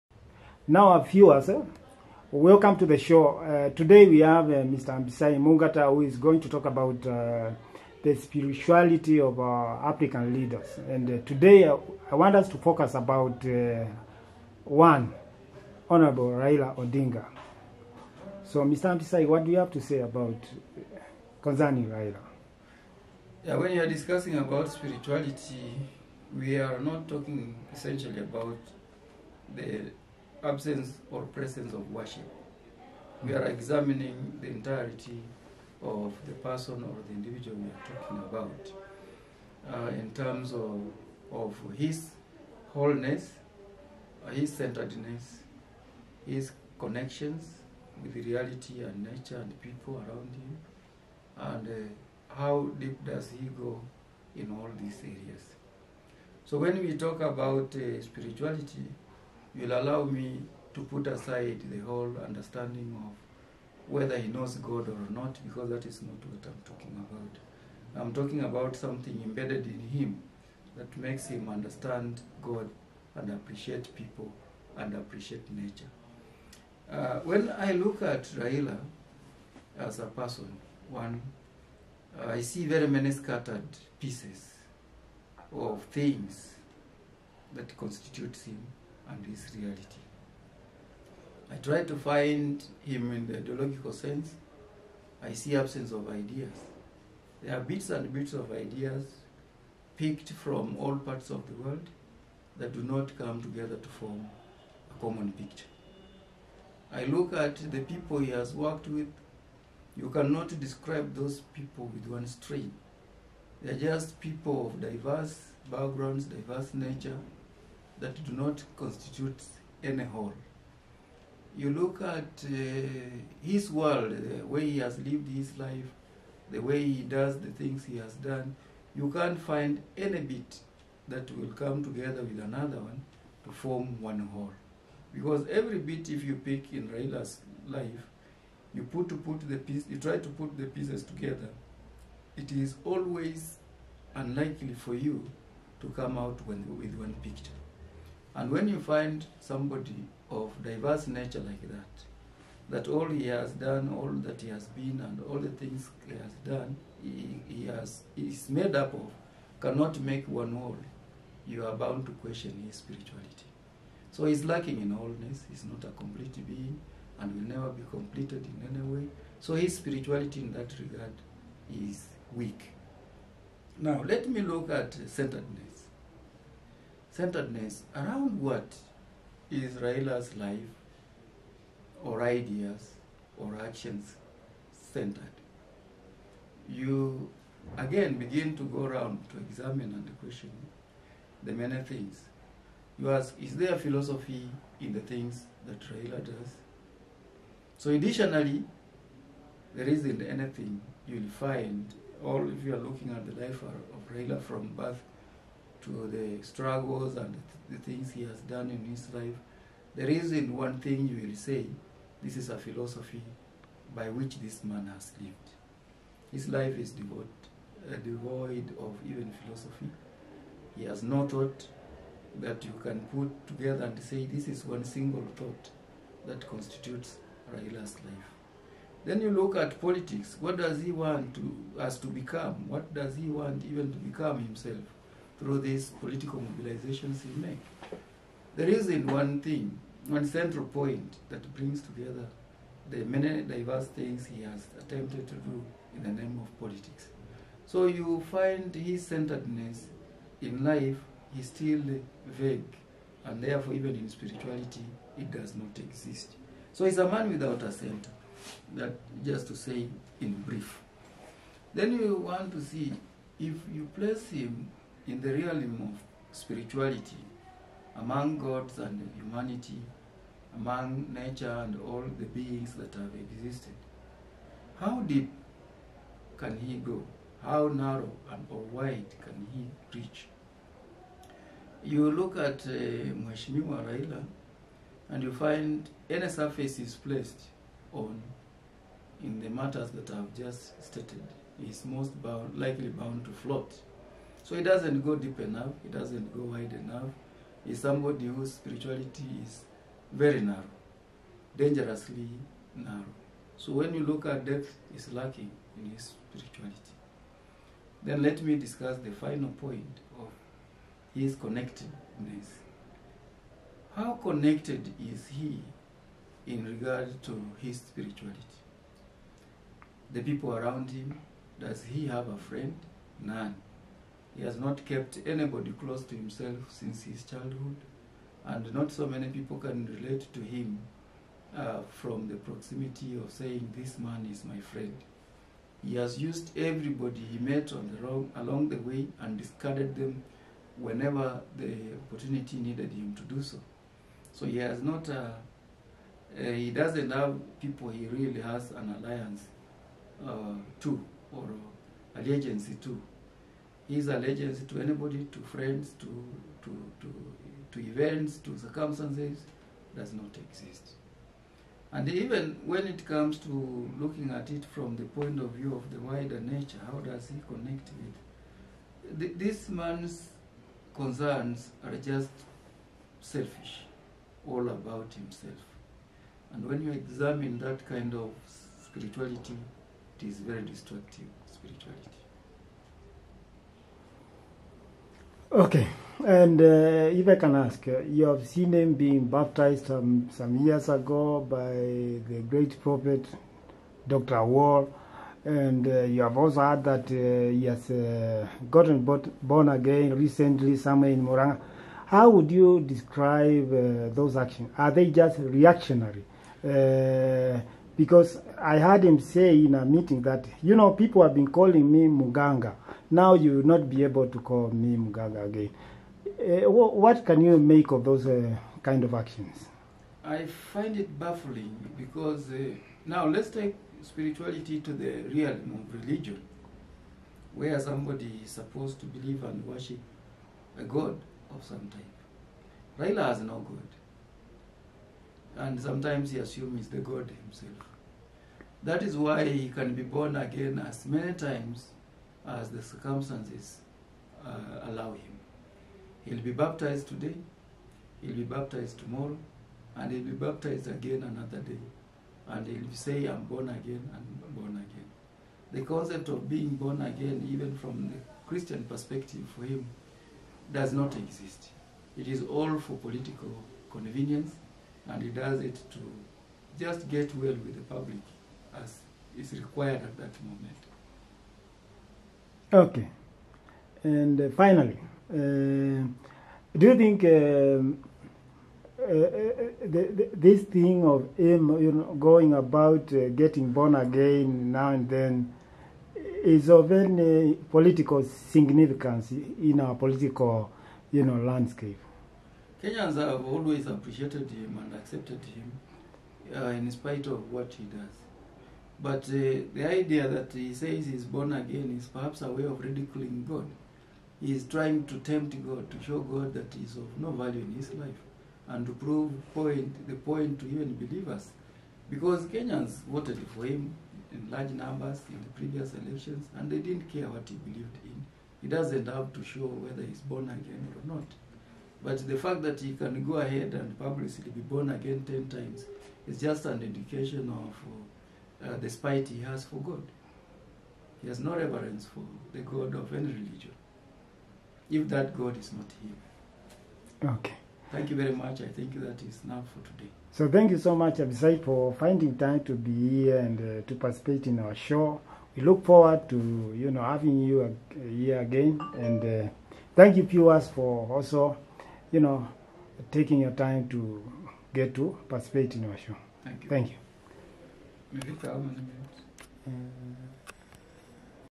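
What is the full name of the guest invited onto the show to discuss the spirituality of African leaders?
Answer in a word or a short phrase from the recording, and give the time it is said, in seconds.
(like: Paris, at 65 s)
Abisai Mungata, at 4 s.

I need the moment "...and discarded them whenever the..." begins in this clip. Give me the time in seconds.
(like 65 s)
339 s.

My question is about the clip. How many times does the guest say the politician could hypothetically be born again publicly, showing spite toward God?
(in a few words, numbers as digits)
10.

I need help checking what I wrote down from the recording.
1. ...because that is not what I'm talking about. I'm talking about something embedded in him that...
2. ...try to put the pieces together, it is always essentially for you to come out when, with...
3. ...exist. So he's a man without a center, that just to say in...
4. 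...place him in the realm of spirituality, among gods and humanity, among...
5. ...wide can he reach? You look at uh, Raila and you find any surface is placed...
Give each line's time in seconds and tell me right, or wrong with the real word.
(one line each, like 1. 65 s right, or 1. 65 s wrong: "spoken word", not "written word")
1. 65 s right
2. 139 s wrong: "unlikely", not "essentially"
3. 255 s right
4. 263 s right
5. 278 s right.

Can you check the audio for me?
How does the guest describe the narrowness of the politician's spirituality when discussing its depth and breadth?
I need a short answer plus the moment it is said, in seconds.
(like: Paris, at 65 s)
dangerously narrow, at 301 s.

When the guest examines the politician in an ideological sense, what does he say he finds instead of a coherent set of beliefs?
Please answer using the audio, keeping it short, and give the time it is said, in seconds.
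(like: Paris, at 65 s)
absence of ideas, at 95 s.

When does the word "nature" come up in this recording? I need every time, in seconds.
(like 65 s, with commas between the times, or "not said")
49 s, 75 s, 116 s, 151 s, 271 s, 366 s.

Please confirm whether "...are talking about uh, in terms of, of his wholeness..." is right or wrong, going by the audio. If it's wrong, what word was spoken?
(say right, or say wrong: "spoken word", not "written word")
right.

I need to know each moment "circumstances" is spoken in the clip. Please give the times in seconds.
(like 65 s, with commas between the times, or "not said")
358 s, 442 s.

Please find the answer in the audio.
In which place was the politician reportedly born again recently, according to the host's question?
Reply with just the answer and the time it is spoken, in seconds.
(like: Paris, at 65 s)
Murang'a, at 401 s.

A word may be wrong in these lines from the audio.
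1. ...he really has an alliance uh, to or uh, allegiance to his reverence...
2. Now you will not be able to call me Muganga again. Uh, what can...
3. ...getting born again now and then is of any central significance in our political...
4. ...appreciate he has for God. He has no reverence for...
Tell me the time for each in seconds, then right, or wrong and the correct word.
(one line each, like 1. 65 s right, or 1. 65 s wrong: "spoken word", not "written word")
1. 347 s wrong: "allegiance", not "reverence"
2. 413 s right
3. 483 s wrong: "political", not "central"
4. 528 s wrong: "spite", not "appreciate".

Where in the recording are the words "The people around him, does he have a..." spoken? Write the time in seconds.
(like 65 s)
320 s.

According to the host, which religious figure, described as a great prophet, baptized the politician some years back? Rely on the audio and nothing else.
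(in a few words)
Dr. Owuor.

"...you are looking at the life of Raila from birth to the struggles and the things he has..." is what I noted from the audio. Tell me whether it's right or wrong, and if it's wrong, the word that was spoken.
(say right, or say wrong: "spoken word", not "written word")
right.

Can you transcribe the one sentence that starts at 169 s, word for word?
So his spirituality in that regard is weak.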